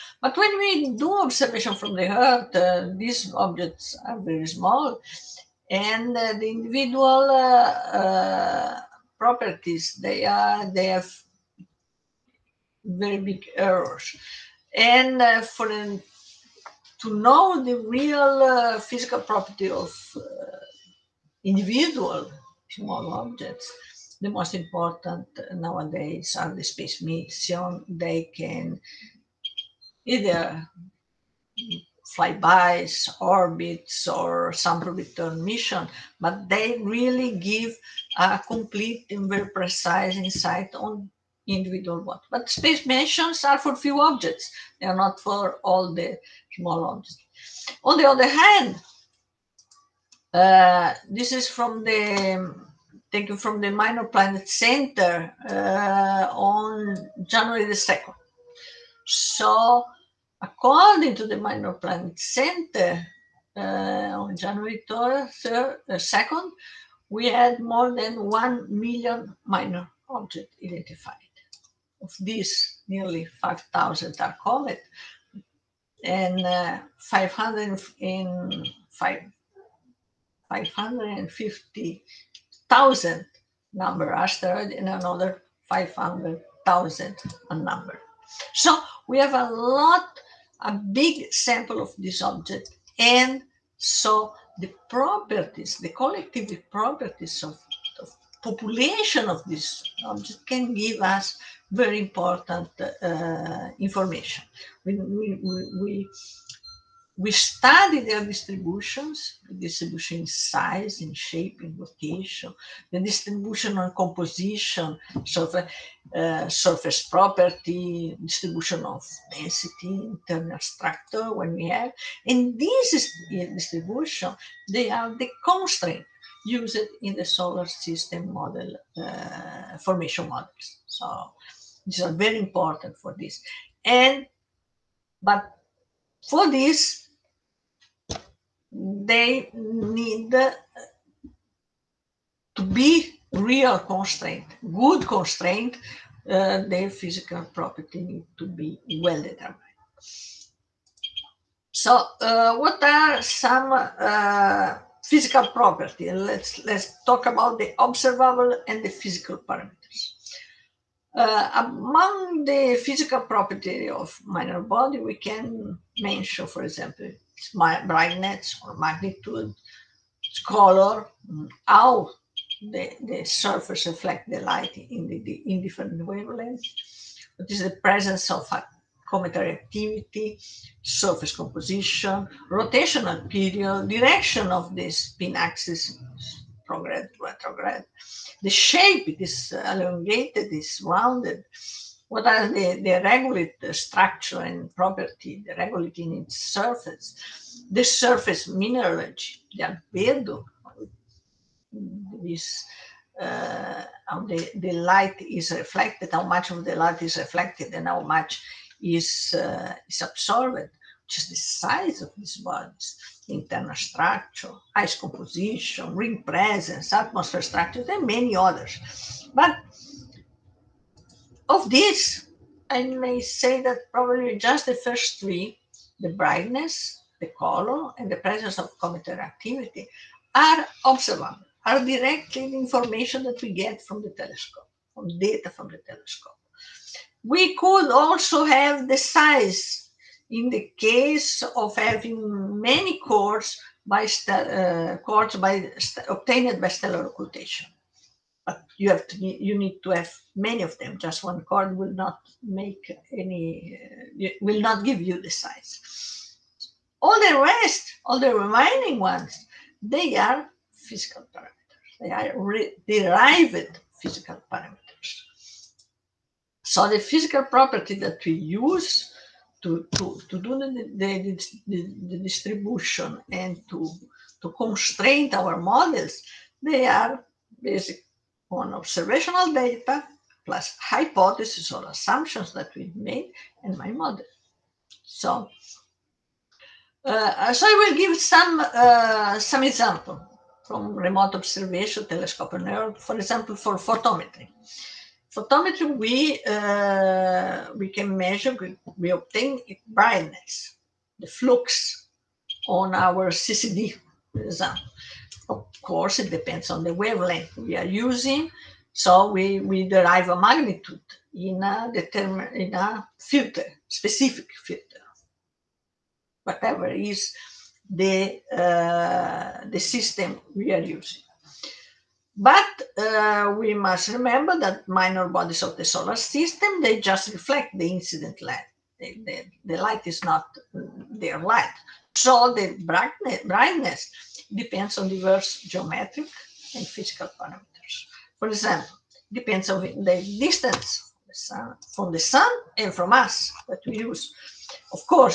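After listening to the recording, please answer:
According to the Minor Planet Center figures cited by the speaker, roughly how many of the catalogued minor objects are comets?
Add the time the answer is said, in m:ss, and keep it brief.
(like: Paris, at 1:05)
nearly 5,000, at 1:12.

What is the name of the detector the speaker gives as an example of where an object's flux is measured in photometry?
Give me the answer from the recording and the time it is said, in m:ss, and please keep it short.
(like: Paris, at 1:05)
CCD, at 5:03.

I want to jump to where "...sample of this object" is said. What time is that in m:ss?
1:31.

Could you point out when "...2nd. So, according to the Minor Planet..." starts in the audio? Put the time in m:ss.
0:57.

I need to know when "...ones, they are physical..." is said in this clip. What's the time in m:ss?
4:18.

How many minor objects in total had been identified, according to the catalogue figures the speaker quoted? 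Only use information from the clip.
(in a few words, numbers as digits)
more than 1 million.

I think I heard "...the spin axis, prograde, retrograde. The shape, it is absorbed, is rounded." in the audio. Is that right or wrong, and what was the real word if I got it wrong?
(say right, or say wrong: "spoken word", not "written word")
wrong: "elongated", not "absorbed".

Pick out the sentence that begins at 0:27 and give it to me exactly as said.
They can either flybys, orbits, or sample return mission, but they really give a complete and very precise insight on individual what.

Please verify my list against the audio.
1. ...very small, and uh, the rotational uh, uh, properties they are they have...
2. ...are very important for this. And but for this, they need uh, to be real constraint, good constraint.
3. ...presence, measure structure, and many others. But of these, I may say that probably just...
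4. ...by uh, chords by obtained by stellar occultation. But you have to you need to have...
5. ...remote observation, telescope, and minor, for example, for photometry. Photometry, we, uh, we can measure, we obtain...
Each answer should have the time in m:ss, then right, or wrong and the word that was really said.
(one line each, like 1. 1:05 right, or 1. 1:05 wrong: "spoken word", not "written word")
1. 0:04 wrong: "individual", not "rotational"
2. 2:12 right
3. 3:36 wrong: "atmosphere", not "measure"
4. 4:03 right
5. 4:50 wrong: "error", not "minor".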